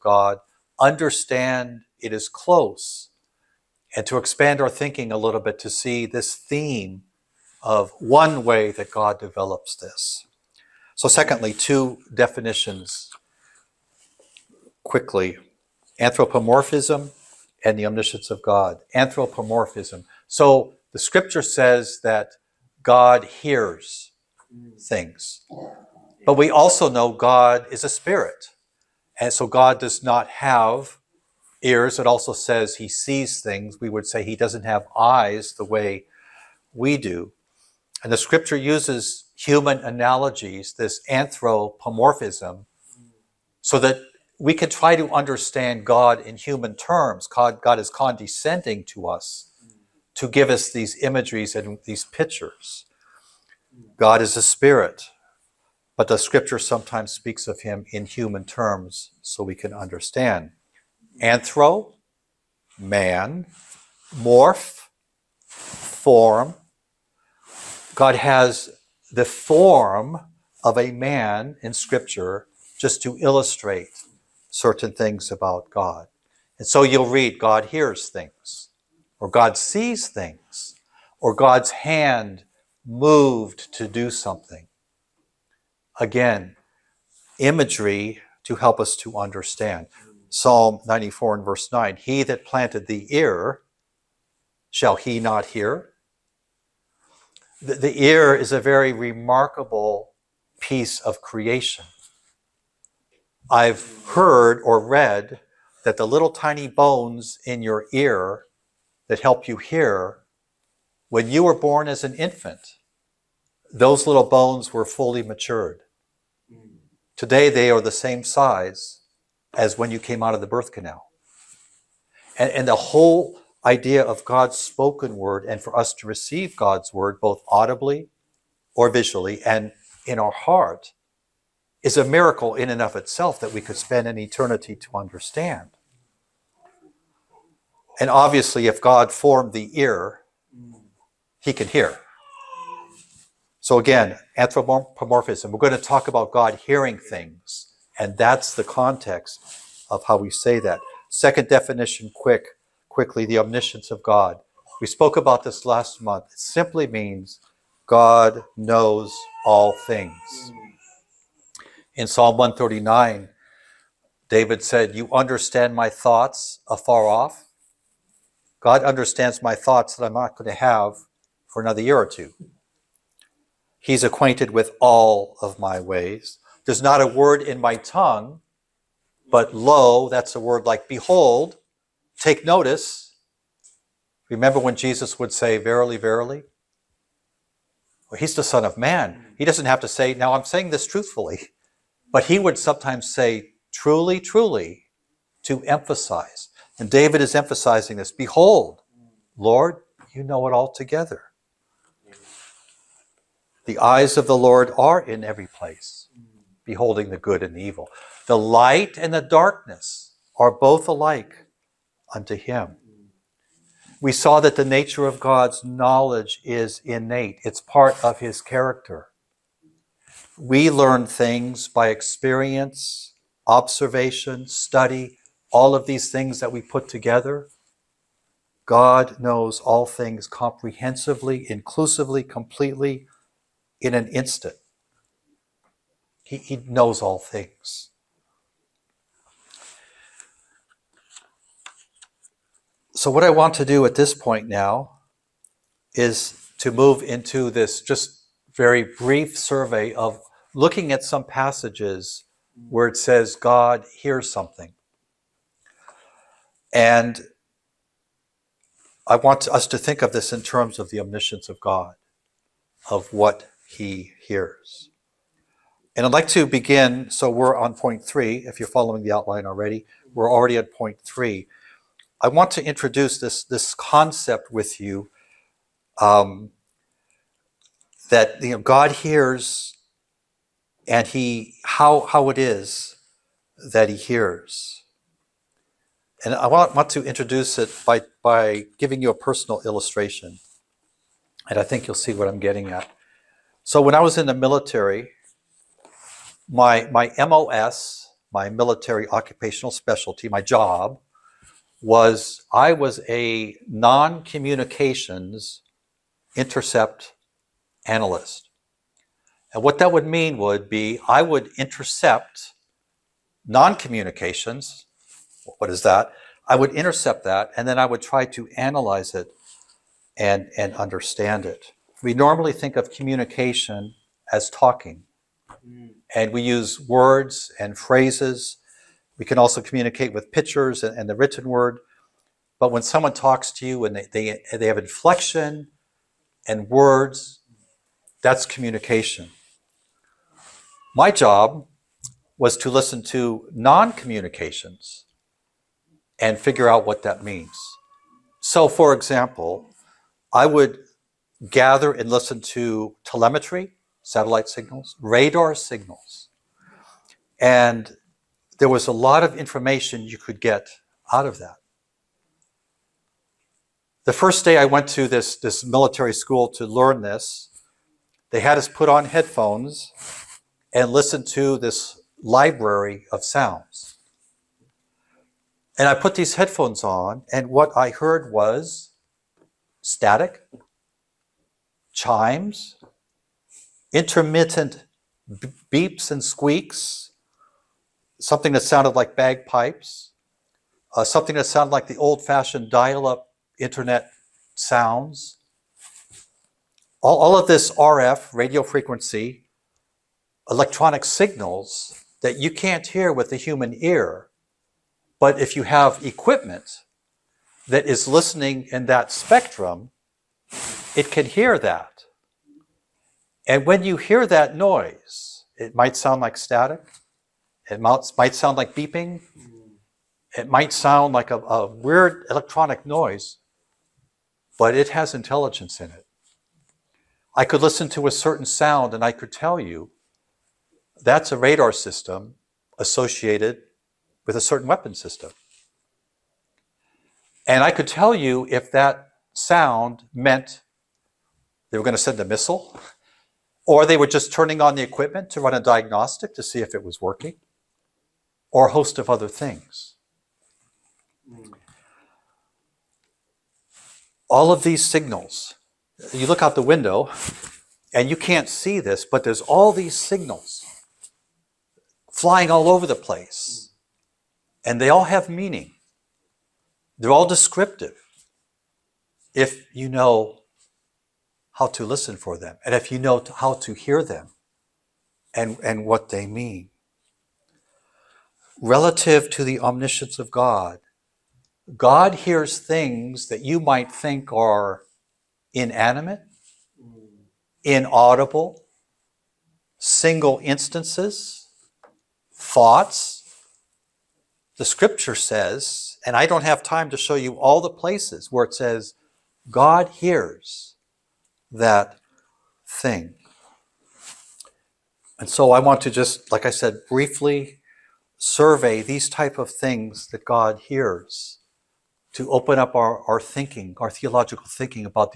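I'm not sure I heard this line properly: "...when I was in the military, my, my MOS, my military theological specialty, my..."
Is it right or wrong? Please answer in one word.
wrong.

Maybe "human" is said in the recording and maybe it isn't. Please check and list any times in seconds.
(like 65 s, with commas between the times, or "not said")
39 s, 46 s, 58 s, 403 s.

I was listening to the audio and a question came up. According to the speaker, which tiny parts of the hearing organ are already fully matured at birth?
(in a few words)
little bones.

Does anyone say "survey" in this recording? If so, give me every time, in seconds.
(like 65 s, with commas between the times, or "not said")
249 s, 508 s.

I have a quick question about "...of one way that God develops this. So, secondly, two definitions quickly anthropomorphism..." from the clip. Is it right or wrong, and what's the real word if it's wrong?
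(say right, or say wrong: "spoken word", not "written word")
right.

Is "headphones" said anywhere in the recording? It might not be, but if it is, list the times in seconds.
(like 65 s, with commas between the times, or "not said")
369 s, 376 s.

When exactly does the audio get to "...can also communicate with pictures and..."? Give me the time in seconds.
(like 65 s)
329 s.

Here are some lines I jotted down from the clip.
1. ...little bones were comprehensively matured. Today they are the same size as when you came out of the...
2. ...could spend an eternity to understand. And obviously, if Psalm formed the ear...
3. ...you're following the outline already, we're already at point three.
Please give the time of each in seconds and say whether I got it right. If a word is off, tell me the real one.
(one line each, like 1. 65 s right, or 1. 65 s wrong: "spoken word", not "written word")
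1. 114 s wrong: "fully", not "comprehensively"
2. 133 s wrong: "God", not "Psalm"
3. 268 s right.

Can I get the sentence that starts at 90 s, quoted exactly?
Psalm 94 and verse 9 He that planted the ear, shall he not hear?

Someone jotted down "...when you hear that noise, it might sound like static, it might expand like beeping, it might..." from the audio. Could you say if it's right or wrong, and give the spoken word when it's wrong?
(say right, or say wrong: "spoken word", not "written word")
wrong: "sound", not "expand".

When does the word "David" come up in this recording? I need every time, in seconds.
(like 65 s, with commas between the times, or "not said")
164 s, 196 s.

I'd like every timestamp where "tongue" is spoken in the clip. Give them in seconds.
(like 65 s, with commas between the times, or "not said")
177 s.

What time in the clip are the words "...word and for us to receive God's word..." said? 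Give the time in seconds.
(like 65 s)
125 s.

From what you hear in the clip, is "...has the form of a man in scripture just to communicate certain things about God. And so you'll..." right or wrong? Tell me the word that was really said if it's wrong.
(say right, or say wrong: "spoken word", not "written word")
wrong: "illustrate", not "communicate".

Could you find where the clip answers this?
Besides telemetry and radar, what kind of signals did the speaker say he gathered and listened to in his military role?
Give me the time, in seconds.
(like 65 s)
354 s.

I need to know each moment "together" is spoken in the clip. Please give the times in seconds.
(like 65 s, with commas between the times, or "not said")
200 s, 226 s.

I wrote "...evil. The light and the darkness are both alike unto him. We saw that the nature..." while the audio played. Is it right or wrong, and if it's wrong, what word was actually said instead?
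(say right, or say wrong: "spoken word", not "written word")
right.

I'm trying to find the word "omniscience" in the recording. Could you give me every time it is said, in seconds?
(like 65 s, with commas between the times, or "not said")
17 s, 153 s, 261 s, 479 s.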